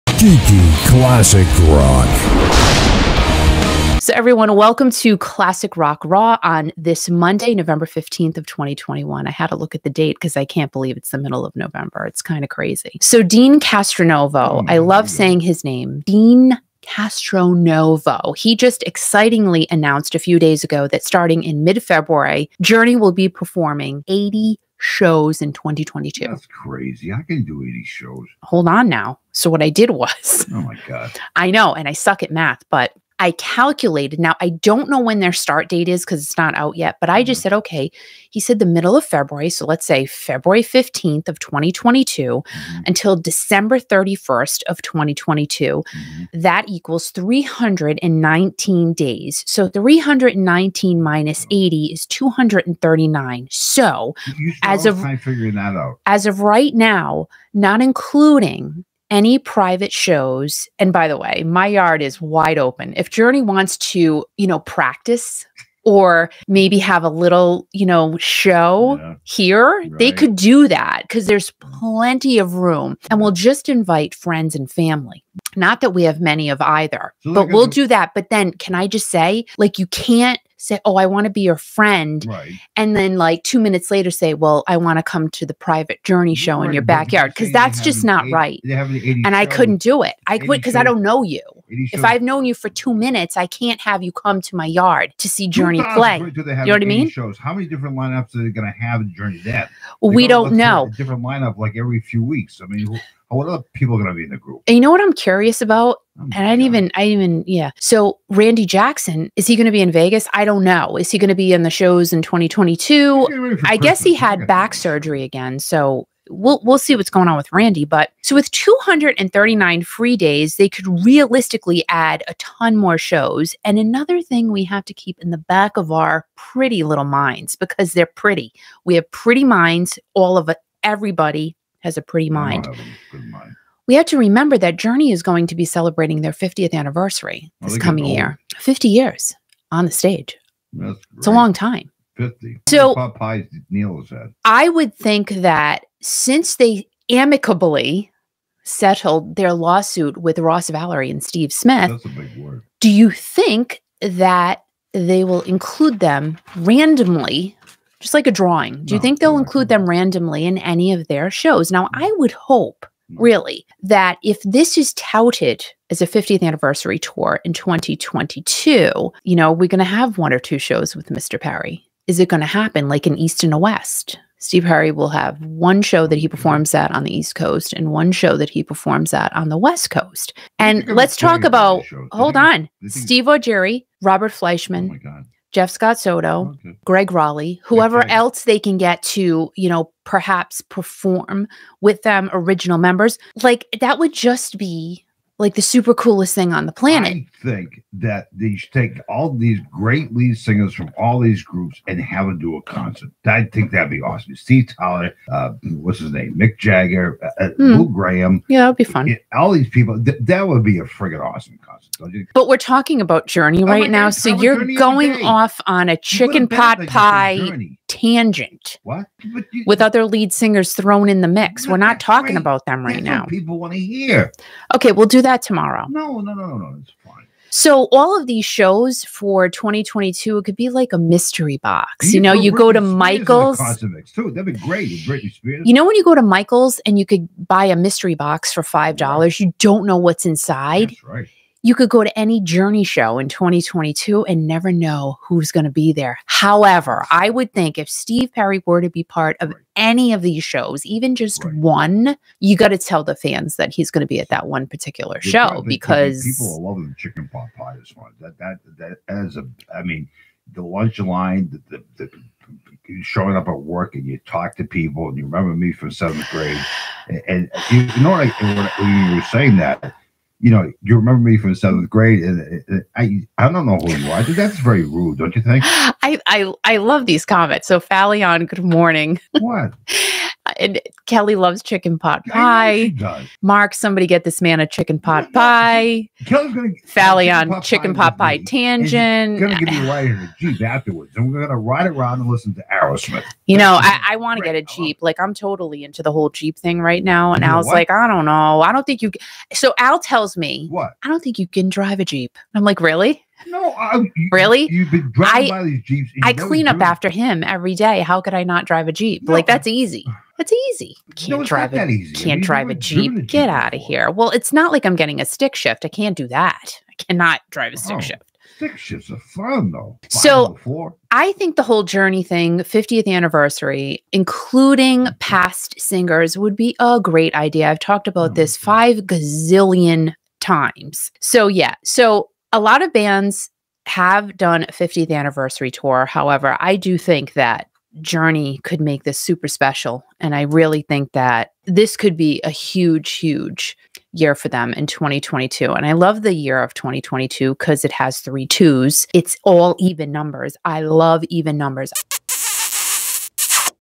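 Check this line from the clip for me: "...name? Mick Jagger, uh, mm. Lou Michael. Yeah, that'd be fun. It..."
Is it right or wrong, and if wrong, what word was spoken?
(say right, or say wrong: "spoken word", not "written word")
wrong: "Gramm", not "Michael".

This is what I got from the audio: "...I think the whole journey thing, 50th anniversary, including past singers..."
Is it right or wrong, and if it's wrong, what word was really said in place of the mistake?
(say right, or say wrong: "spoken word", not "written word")
right.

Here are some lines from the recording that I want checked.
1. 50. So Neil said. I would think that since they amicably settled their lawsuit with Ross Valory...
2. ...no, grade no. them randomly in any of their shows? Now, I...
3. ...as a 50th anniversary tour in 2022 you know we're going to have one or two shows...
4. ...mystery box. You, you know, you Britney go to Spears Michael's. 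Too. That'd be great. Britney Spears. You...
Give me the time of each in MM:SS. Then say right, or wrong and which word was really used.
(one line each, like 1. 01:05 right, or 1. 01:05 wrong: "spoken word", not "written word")
1. 02:22 right
2. 02:39 wrong: "include", not "grade"
3. 02:45 right
4. 03:50 right.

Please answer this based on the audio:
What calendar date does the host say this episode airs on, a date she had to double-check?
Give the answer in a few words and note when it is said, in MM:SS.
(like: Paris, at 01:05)
November 15th, at 00:07.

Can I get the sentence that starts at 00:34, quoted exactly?
Now, I don't know when their start date is because it's not out yet, but I just mm-hmm.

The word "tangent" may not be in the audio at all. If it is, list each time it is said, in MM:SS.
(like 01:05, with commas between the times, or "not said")
03:37, 04:48.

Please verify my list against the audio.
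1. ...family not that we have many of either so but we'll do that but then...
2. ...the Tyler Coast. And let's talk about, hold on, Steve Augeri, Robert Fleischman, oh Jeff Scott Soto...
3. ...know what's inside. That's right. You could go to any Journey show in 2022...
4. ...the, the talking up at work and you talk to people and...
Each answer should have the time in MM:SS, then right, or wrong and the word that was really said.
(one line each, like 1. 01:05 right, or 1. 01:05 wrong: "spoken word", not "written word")
1. 01:14 right
2. 02:59 wrong: "West", not "Tyler"
3. 03:59 right
4. 04:21 wrong: "showing", not "talking".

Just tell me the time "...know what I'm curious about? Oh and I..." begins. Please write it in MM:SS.
01:44.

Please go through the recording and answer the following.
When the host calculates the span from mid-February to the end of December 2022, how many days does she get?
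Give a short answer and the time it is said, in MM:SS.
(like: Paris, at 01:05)
319, at 00:47.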